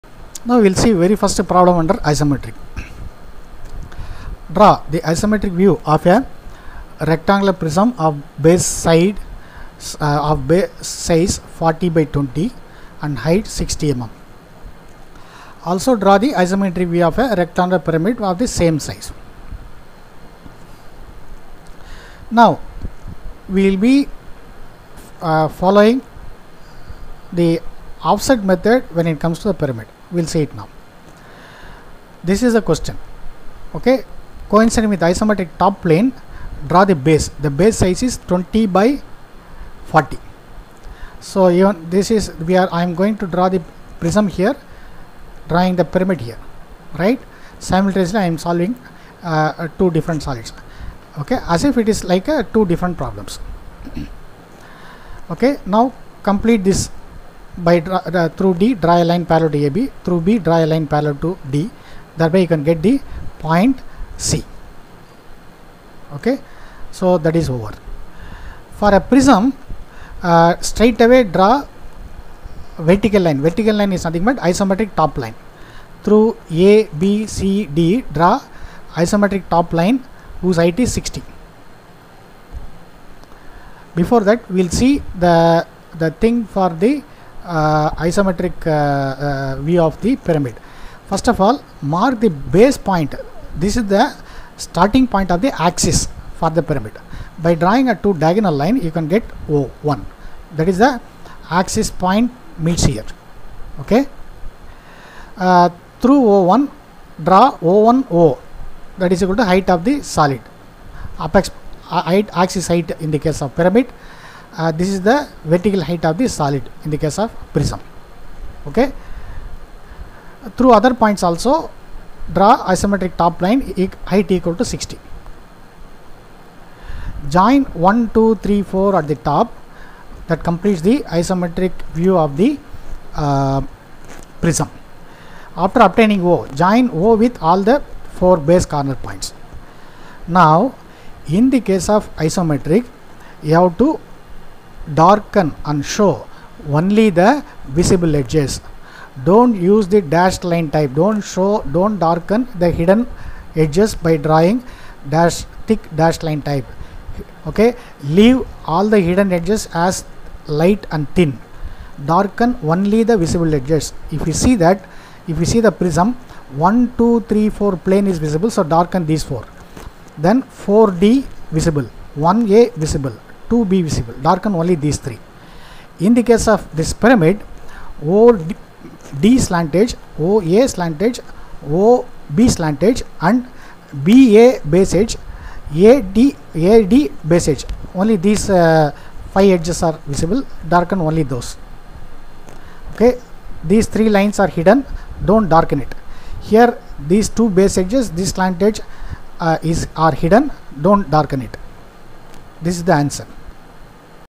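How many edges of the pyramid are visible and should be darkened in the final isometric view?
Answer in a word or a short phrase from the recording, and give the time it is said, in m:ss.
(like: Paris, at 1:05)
5, at 3:09.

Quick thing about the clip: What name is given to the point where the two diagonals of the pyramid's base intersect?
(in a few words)
O1.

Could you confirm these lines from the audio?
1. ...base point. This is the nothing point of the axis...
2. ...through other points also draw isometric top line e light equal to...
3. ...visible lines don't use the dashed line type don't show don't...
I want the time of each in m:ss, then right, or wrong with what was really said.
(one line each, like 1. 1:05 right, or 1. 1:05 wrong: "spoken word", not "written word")
1. 1:32 wrong: "starting", not "nothing"
2. 2:00 wrong: "height", not "light"
3. 2:27 wrong: "edges", not "lines".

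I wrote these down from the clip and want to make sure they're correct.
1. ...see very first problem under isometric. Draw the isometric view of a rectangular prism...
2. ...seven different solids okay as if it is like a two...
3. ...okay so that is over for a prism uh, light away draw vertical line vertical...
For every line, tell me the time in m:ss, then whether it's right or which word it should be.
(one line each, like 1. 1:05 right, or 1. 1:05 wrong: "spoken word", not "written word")
1. 0:00 right
2. 0:49 wrong: "two", not "seven"
3. 1:06 wrong: "straight", not "light".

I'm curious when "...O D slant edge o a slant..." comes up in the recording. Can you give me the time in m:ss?
2:58.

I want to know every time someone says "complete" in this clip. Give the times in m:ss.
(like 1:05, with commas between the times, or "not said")
0:56, 2:10.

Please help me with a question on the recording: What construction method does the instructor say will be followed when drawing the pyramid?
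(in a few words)
offset method.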